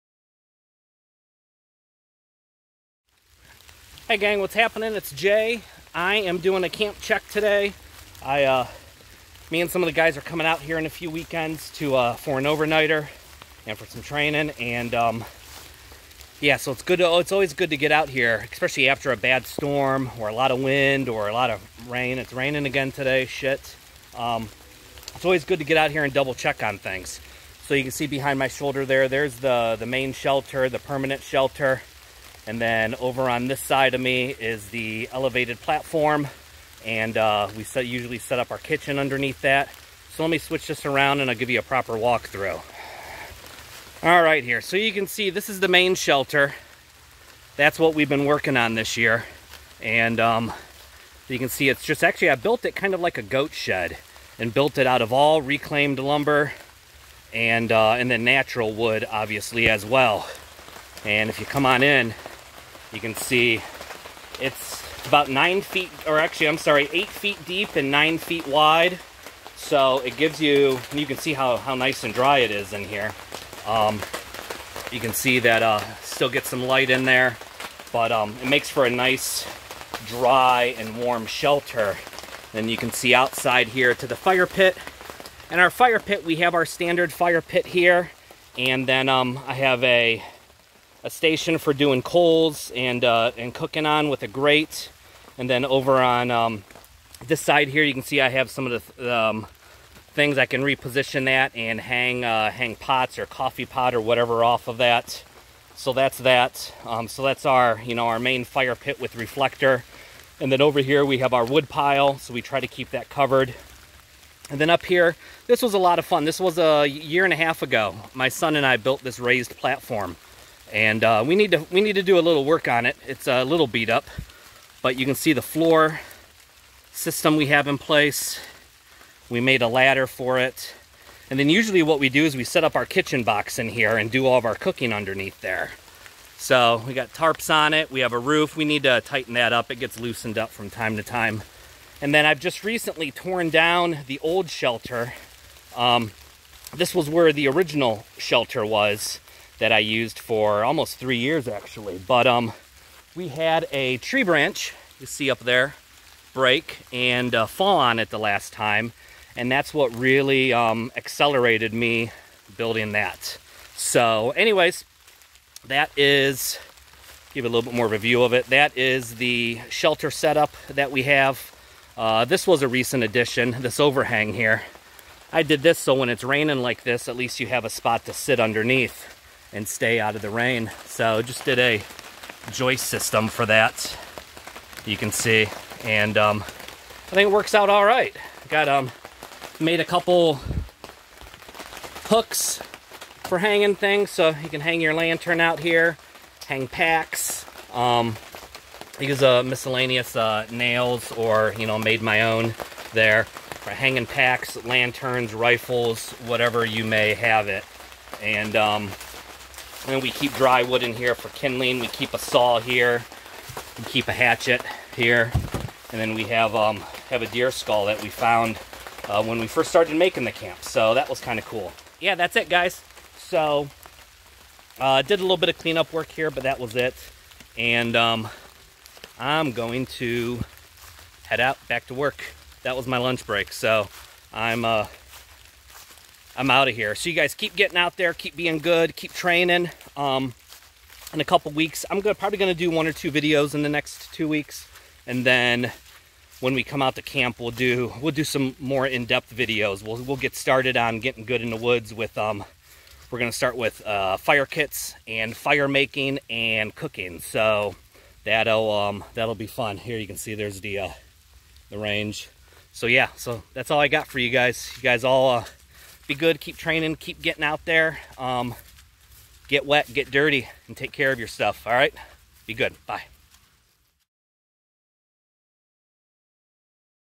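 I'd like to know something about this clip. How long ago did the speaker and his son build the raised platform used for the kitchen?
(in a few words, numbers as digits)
A year and a half.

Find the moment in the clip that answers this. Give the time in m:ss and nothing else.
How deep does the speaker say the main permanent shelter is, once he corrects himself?
1:06.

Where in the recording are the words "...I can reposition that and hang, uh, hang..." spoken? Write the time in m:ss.
1:40.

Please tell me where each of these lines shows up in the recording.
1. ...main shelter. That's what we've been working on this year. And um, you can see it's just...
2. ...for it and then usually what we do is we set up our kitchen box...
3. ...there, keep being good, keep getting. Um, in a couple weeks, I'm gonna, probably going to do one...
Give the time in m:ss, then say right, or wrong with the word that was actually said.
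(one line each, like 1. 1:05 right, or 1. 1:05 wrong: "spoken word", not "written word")
1. 0:45 right
2. 2:10 right
3. 3:57 wrong: "training", not "getting".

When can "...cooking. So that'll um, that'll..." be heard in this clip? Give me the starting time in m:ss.
4:16.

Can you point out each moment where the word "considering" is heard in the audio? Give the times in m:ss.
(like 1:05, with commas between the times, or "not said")
not said.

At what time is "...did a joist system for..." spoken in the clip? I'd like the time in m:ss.
3:01.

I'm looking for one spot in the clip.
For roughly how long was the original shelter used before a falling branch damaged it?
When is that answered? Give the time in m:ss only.
2:30.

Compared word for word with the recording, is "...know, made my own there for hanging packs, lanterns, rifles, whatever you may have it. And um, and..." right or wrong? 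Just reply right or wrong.
right.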